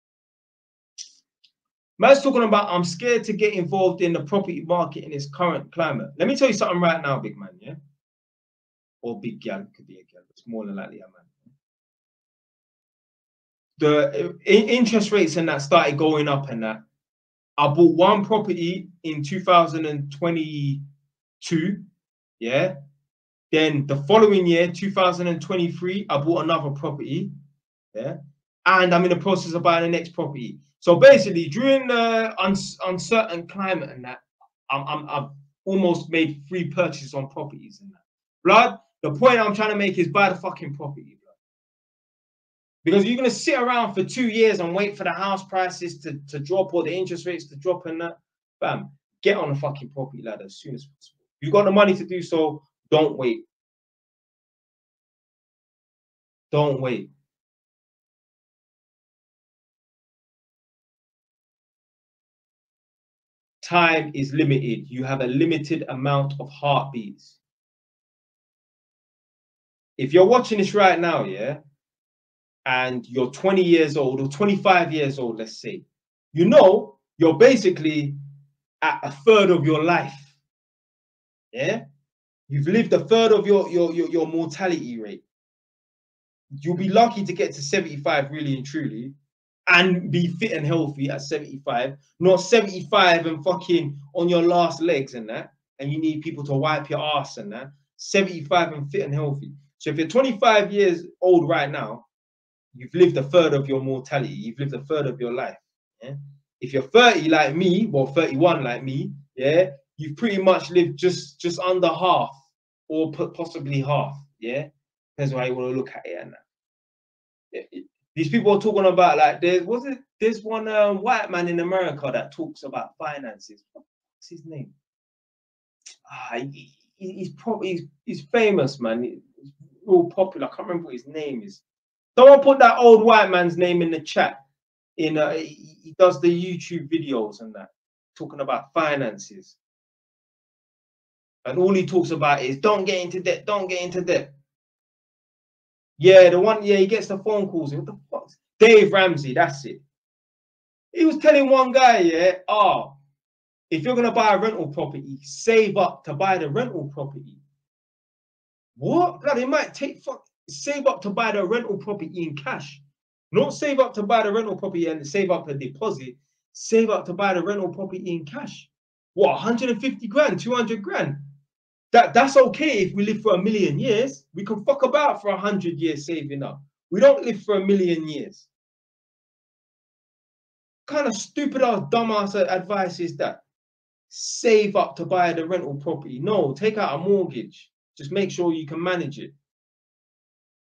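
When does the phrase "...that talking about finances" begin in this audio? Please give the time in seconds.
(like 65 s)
137 s.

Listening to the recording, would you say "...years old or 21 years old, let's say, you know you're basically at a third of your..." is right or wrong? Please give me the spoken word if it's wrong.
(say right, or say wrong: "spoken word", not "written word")
wrong: "25", not "21".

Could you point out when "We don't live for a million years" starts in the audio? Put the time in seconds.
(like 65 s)
176 s.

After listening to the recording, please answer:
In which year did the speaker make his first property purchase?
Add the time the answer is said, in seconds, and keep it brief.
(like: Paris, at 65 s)
2022, at 19 s.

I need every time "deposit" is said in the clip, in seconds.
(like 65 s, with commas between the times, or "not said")
165 s.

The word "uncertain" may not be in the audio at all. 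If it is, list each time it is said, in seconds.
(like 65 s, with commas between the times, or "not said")
32 s.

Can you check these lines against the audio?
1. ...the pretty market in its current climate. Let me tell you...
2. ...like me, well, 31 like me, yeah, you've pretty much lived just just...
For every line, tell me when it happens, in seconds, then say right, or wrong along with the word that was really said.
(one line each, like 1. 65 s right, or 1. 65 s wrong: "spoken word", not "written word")
1. 4 s wrong: "property", not "pretty"
2. 107 s right.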